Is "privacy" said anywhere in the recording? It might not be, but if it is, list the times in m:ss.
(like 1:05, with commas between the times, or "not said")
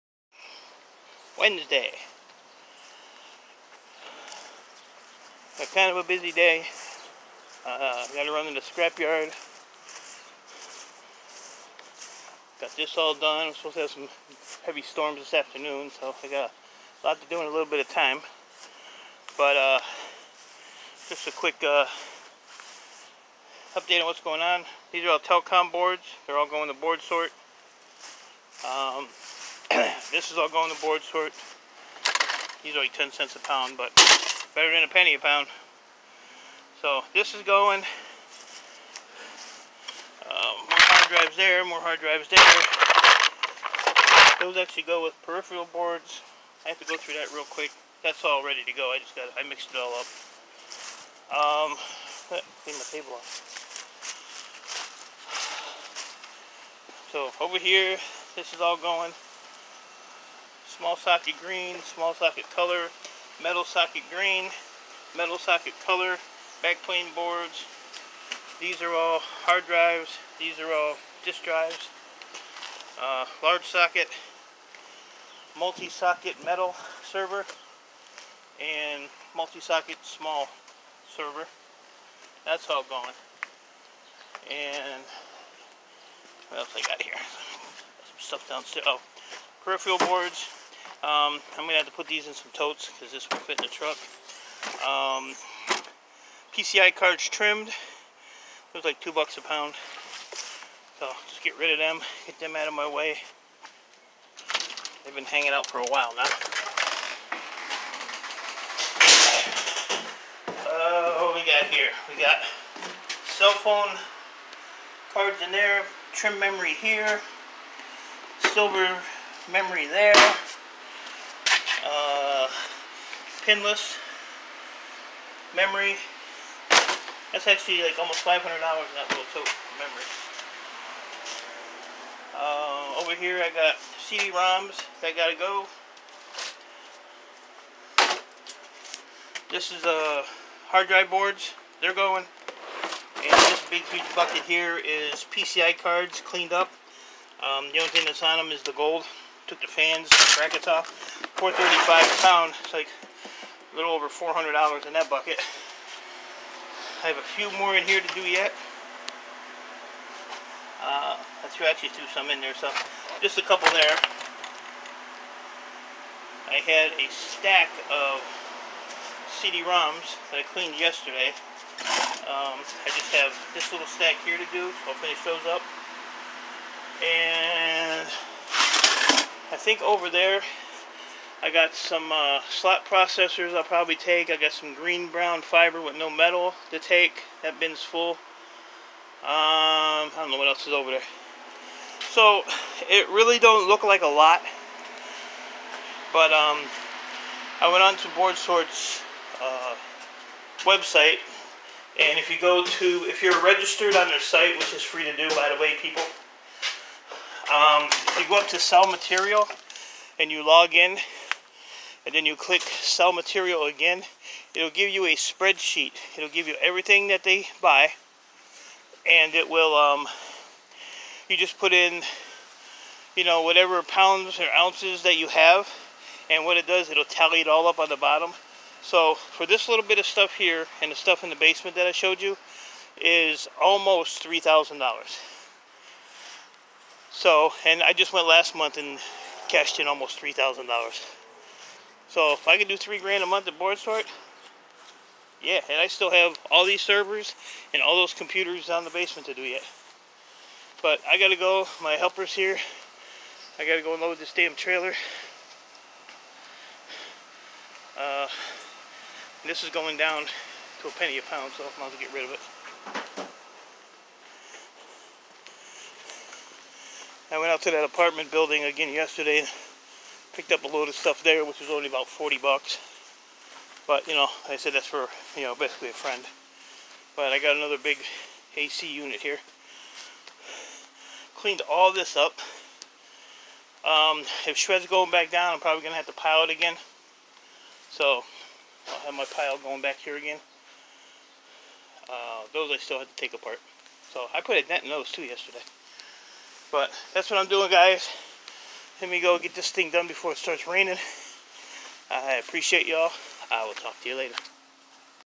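not said.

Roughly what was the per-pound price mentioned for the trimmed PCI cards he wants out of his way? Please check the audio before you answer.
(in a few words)
2 bucks.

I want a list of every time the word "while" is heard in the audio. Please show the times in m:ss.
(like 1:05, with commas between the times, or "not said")
1:45.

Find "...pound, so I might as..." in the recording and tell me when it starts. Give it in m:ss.
4:21.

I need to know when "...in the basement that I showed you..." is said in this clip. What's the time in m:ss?
3:51.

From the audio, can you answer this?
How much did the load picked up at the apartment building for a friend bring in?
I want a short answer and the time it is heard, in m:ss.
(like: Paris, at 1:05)
40 bucks, at 4:32.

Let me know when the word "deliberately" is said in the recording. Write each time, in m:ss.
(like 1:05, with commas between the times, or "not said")
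not said.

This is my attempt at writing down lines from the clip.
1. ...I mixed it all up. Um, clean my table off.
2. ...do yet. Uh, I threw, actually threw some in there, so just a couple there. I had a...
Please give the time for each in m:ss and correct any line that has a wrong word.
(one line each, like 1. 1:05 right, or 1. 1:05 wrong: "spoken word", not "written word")
1. 0:49 right
2. 2:38 right.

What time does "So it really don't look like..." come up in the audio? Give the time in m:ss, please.
3:12.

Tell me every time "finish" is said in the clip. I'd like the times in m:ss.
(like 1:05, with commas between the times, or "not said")
2:54.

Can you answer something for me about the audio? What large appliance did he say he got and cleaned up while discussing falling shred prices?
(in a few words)
AC unit.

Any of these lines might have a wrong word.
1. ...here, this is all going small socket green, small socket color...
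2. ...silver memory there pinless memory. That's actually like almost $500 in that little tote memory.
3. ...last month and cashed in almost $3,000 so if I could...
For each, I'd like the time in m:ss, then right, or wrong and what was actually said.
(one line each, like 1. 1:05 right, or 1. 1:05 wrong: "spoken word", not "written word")
1. 0:57 right
2. 1:58 right
3. 3:58 right.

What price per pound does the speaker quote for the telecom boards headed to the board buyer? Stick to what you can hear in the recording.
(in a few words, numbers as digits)
10 cents.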